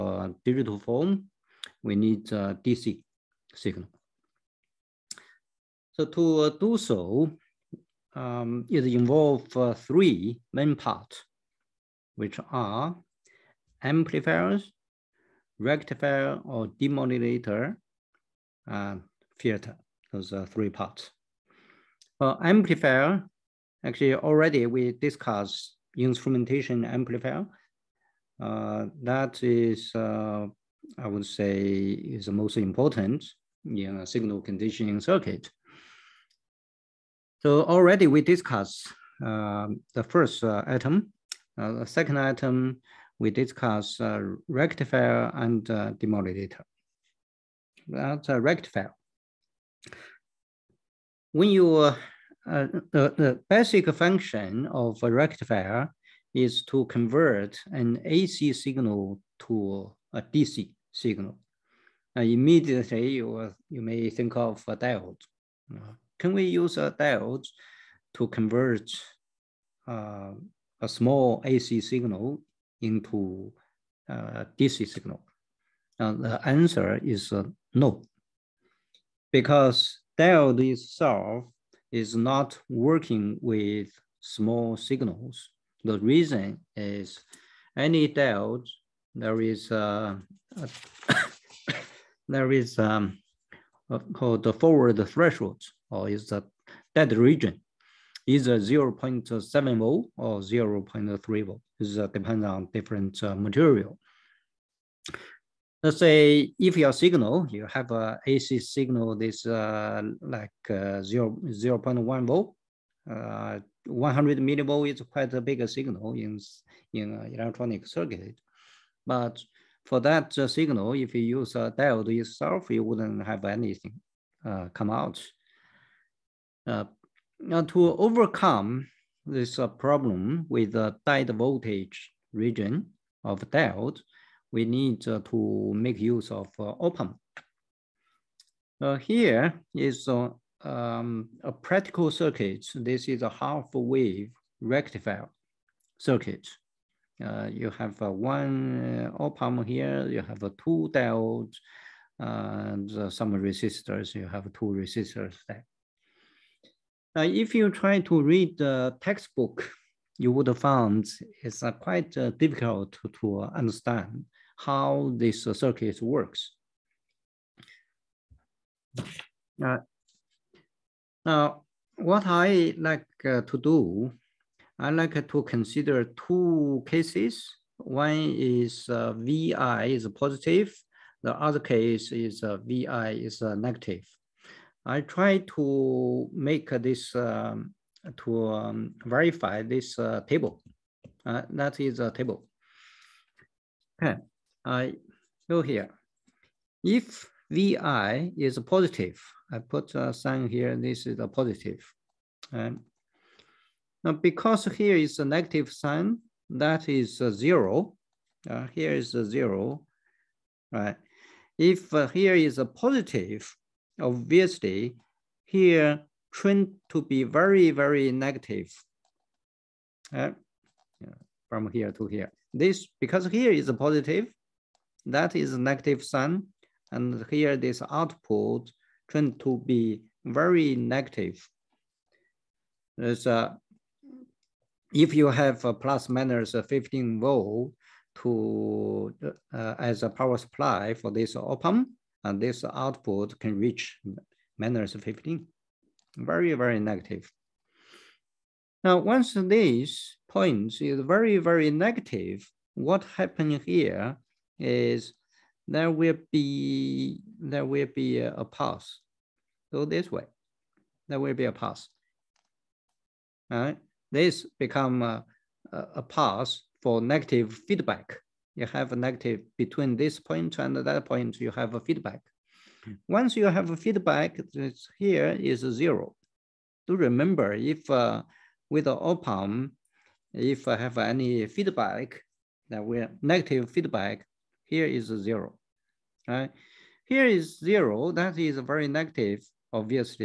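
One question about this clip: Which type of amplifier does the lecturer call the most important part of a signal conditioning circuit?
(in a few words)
Instrumentation amplifier.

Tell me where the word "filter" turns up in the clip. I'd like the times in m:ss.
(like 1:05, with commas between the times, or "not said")
0:19.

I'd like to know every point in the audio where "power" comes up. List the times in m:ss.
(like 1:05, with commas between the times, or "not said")
4:00.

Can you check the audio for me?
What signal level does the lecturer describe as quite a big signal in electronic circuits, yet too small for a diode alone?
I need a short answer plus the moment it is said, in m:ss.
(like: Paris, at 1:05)
100 millivolts, at 1:53.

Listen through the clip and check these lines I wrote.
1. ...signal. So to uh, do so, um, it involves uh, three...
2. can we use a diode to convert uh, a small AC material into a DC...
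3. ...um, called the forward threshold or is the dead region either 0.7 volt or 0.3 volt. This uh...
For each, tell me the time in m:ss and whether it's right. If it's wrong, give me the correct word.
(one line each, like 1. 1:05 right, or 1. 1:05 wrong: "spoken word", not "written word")
1. 0:03 right
2. 1:06 wrong: "signal", not "material"
3. 1:32 right.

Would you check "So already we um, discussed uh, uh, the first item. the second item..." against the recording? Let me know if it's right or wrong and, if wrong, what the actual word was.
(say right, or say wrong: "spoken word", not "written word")
right.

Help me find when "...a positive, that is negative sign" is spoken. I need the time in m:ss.
3:43.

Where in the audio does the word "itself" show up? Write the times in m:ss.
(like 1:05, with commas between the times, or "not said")
1:20, 2:02.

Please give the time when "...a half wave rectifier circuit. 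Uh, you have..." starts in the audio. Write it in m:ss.
2:23.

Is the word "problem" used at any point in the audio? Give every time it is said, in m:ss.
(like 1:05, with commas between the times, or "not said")
2:09.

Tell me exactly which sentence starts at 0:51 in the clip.
When you uh, uh, the, the basic function of a rectifier is to convert an AC signal to a DC signal.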